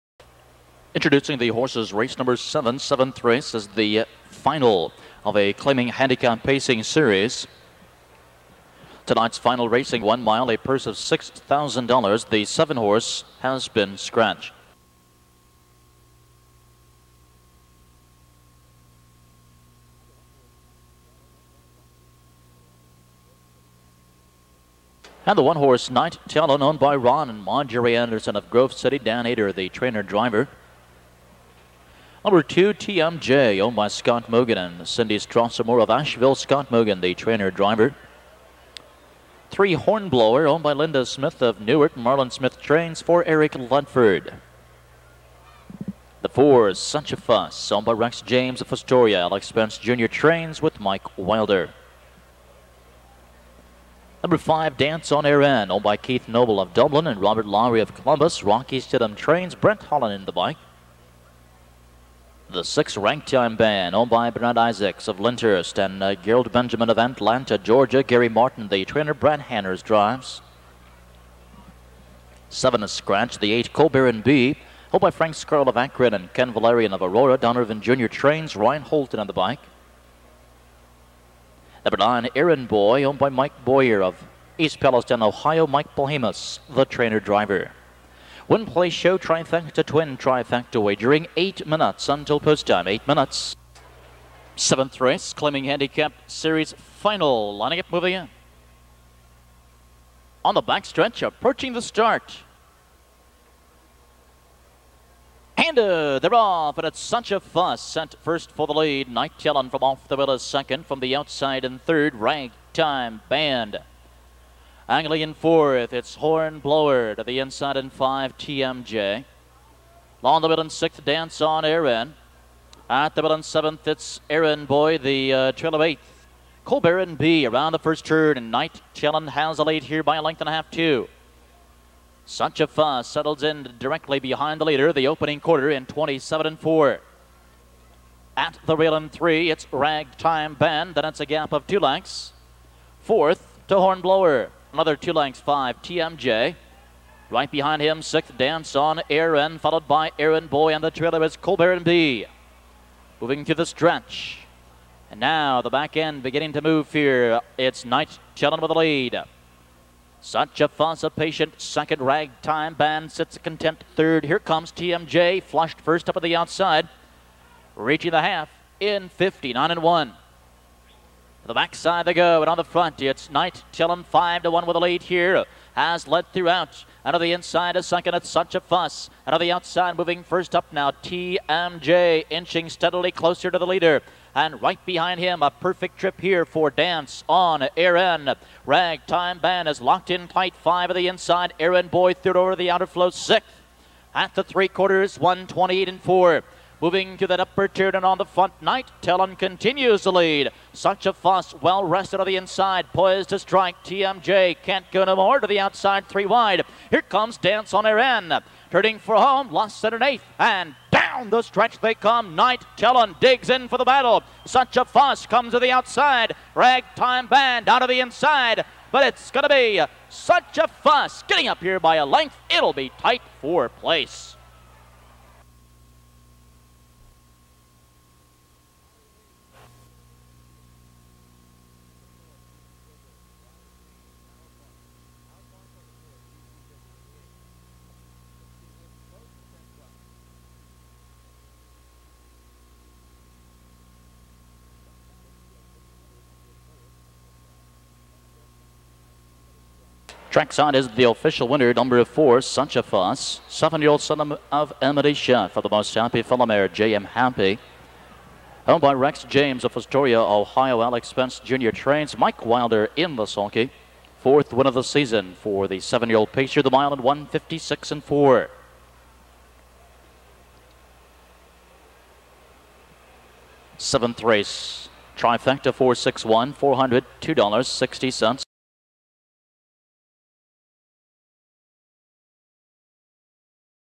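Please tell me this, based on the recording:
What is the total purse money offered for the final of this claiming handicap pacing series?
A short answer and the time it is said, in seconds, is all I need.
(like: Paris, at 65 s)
$6,000, at 10 s.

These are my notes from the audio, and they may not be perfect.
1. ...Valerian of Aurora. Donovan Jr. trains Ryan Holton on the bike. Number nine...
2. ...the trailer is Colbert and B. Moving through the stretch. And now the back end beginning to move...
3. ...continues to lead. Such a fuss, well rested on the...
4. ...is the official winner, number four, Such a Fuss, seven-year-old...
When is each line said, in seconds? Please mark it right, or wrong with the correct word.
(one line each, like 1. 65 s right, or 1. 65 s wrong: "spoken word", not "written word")
1. 76 s right
2. 150 s right
3. 199 s right
4. 250 s right.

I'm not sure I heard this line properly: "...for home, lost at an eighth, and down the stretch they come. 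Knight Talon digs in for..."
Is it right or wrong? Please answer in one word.
right.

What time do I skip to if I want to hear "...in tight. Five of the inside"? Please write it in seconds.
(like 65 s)
190 s.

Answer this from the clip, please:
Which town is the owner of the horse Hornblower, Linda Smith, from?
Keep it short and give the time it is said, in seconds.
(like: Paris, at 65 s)
Newark, at 41 s.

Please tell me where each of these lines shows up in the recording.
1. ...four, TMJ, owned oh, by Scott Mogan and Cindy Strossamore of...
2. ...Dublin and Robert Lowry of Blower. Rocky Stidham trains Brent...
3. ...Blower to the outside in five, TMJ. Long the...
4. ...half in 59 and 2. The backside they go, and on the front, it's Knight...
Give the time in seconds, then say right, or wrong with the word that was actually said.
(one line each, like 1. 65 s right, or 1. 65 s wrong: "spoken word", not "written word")
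1. 32 s wrong: "two", not "four"
2. 56 s wrong: "Columbus", not "Blower"
3. 116 s wrong: "inside", not "outside"
4. 168 s wrong: "1", not "2".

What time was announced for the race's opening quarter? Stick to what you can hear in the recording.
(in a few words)
27 and 4.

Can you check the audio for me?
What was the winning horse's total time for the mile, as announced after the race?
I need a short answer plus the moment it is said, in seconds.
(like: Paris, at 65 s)
1:56.4, at 267 s.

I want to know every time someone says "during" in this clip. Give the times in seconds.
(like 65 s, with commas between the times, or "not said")
91 s.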